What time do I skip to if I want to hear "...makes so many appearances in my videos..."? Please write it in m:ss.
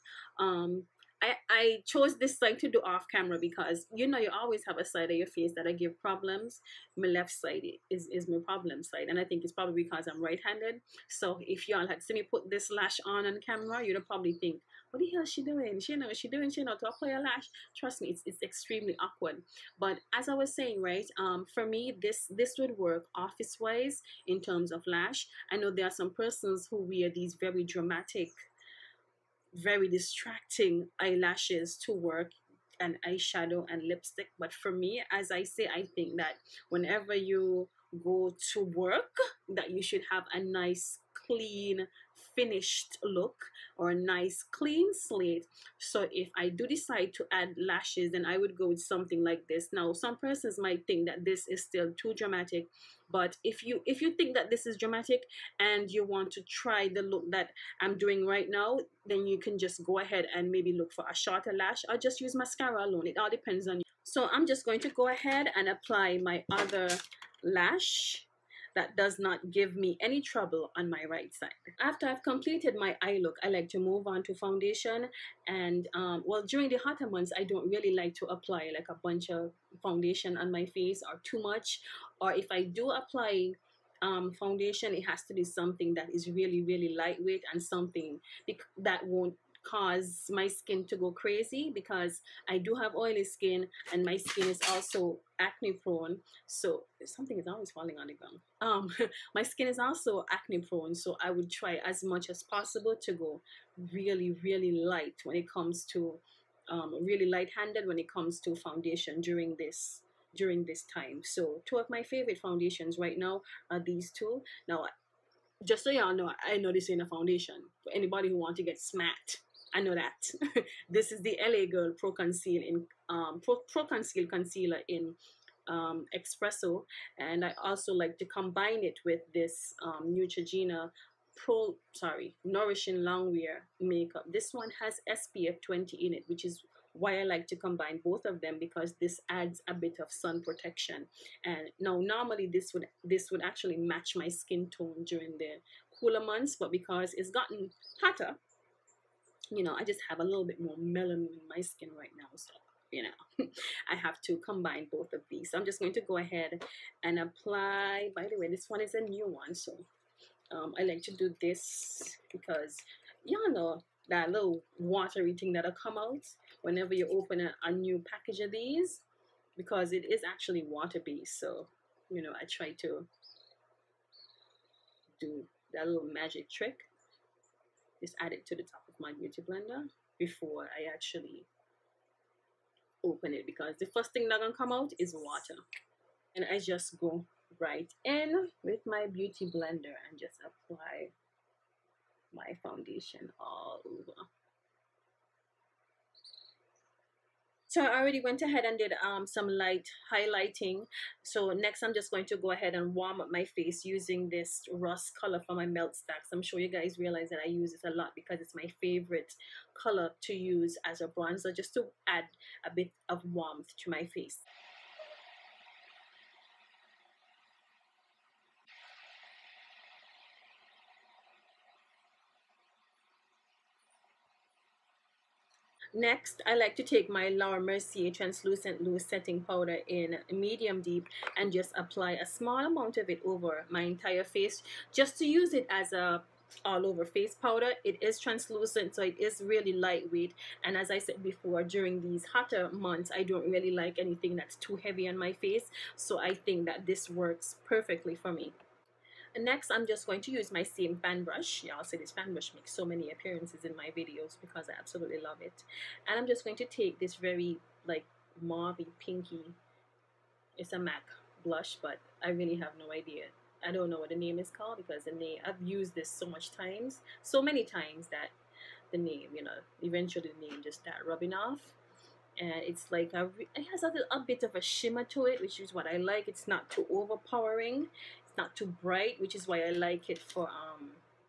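4:12.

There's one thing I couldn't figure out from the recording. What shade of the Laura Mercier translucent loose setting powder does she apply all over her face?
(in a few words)
Medium deep.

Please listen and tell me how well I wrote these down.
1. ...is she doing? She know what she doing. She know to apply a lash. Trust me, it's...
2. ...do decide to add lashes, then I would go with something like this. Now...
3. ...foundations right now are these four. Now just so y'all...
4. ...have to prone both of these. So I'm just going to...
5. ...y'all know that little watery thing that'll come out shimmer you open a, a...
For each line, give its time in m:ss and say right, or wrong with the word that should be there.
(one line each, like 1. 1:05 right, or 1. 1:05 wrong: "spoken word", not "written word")
1. 0:15 right
2. 0:46 right
3. 1:52 wrong: "two", not "four"
4. 2:33 wrong: "combine", not "prone"
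5. 2:43 wrong: "whenever", not "shimmer".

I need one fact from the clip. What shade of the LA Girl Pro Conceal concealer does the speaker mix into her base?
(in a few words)
Espresso.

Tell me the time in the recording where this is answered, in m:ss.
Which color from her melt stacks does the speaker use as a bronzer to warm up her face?
3:24.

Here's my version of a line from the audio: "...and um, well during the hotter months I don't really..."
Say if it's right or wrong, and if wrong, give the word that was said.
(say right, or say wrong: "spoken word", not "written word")
right.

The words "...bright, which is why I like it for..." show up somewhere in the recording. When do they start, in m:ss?
4:38.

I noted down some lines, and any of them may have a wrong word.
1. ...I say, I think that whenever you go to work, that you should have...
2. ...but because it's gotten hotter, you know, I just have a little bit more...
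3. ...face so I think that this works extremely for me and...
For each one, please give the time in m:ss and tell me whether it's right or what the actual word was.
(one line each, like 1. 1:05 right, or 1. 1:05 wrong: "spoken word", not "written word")
1. 0:35 right
2. 2:26 right
3. 4:05 wrong: "perfectly", not "extremely".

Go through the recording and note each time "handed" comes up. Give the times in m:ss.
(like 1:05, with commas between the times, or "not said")
0:10, 1:47.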